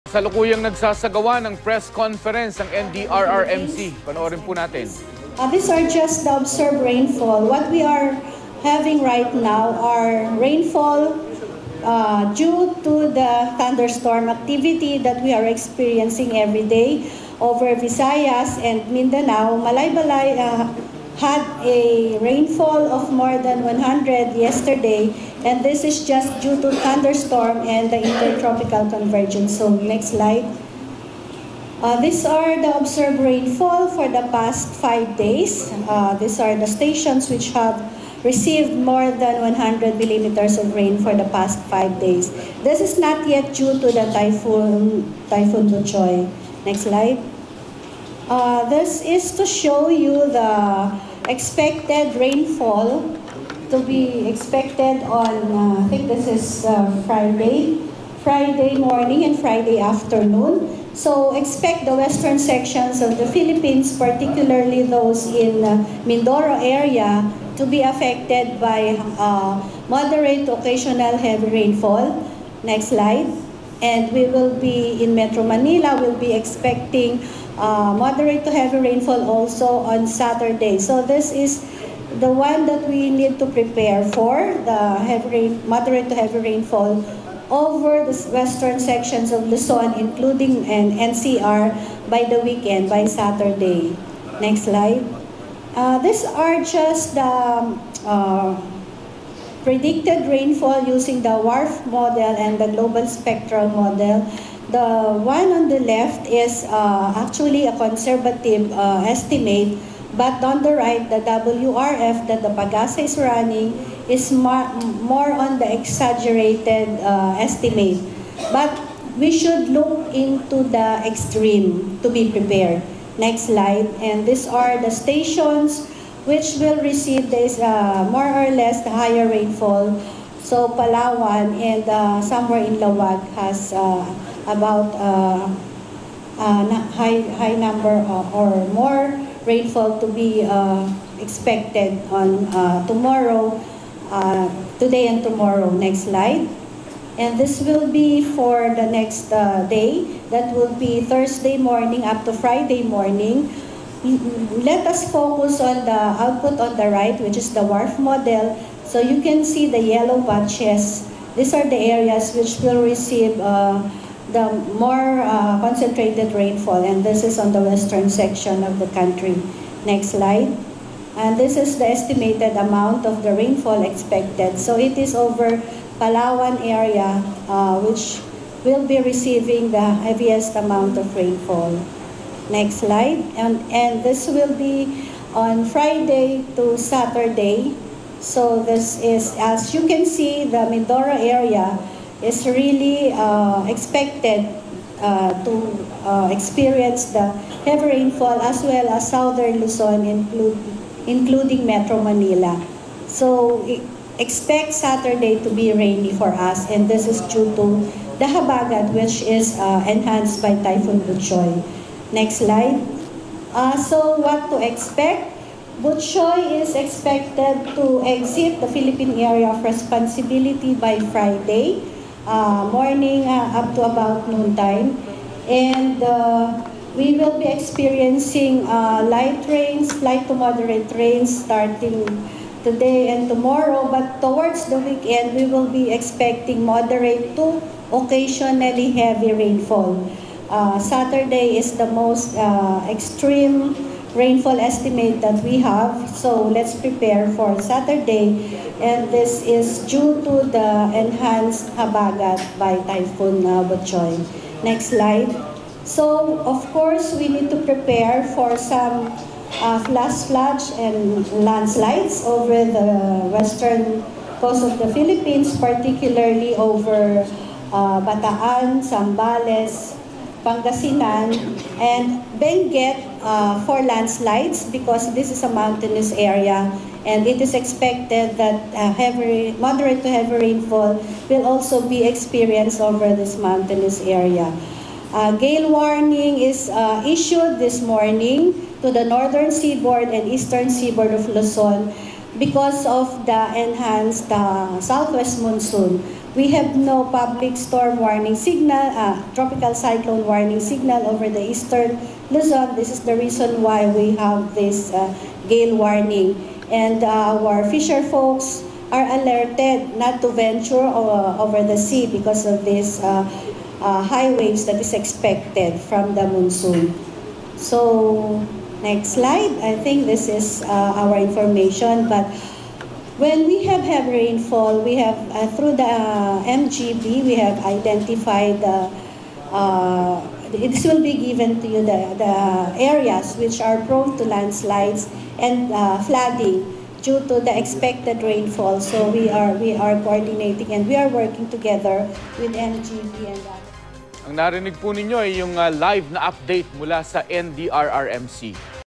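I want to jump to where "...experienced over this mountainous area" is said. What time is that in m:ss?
4:42.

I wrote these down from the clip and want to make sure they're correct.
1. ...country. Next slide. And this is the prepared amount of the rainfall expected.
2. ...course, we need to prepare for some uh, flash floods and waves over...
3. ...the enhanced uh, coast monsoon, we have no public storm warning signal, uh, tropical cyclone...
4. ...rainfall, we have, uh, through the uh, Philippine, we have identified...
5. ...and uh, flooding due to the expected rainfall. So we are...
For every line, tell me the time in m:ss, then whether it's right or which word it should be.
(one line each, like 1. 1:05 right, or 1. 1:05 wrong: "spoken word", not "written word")
1. 2:48 wrong: "estimated", not "prepared"
2. 4:16 wrong: "landslides", not "waves"
3. 4:53 wrong: "southwest", not "coast"
4. 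5:24 wrong: "MGB", not "Philippine"
5. 5:35 right.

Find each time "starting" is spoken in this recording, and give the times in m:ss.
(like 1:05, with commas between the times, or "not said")
3:51.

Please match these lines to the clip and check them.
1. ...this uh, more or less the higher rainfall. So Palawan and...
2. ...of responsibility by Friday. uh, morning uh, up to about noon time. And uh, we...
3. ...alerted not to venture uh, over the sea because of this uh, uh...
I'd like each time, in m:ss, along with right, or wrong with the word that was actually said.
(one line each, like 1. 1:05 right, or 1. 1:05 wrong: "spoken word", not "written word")
1. 2:07 right
2. 3:39 right
3. 5:09 right.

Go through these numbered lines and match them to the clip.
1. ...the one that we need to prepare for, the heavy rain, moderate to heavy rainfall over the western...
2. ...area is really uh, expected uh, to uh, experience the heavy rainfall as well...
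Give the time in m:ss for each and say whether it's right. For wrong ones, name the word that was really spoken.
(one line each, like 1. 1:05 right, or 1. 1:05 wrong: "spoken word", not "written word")
1. 1:22 right
2. 3:11 right.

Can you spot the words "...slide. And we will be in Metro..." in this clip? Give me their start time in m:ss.
1:12.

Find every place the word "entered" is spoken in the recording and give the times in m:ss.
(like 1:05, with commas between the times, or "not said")
not said.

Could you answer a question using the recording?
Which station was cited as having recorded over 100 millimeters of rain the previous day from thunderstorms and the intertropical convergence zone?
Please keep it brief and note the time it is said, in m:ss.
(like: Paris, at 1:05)
Malaybalay, at 0:19.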